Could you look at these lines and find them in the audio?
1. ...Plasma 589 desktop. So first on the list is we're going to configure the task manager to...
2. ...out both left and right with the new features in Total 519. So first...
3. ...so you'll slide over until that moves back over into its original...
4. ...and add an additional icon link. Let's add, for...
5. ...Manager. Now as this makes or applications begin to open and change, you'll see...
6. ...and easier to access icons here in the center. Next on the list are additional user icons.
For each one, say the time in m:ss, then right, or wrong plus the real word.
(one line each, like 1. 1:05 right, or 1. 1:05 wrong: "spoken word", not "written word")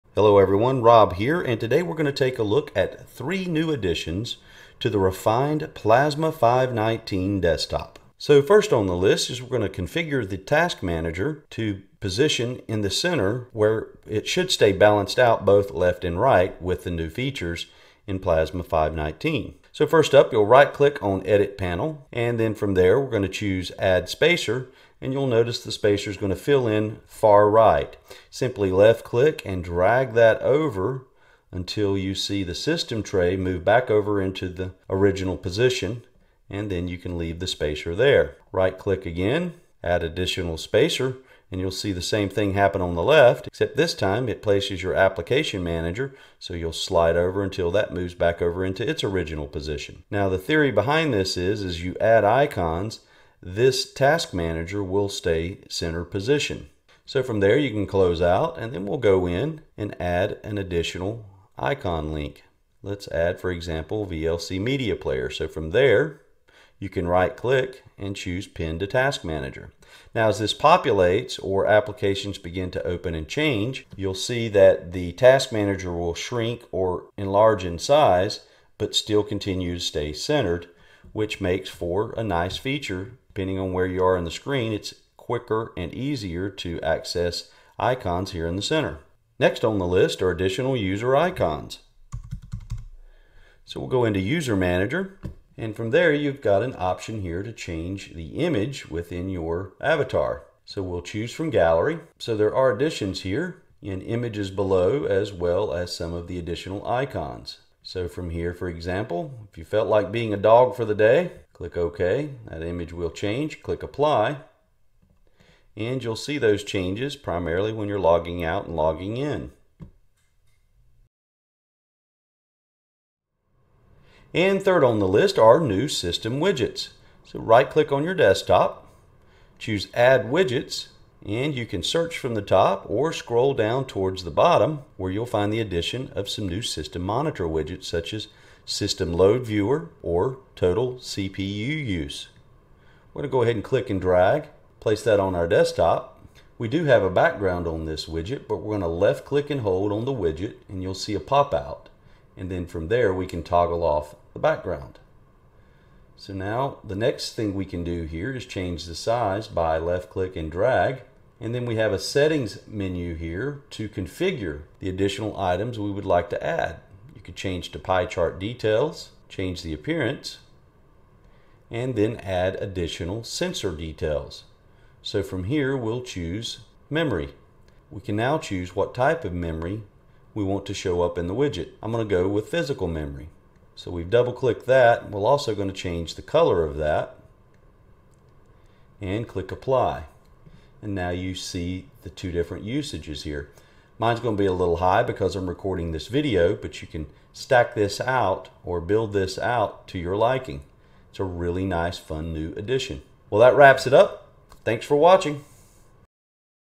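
1. 0:05 wrong: "519", not "589"
2. 0:15 wrong: "Plasma", not "Total"
3. 0:46 right
4. 0:59 right
5. 1:09 wrong: "populates", not "makes"
6. 1:25 right.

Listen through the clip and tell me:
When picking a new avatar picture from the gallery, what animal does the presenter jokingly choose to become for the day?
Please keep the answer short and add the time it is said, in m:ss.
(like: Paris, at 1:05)
Dog, at 1:50.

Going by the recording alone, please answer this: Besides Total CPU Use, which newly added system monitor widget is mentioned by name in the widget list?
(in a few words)
System Load Viewer.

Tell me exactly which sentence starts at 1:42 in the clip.
So there are additions here in images below as well as some of the additional icons.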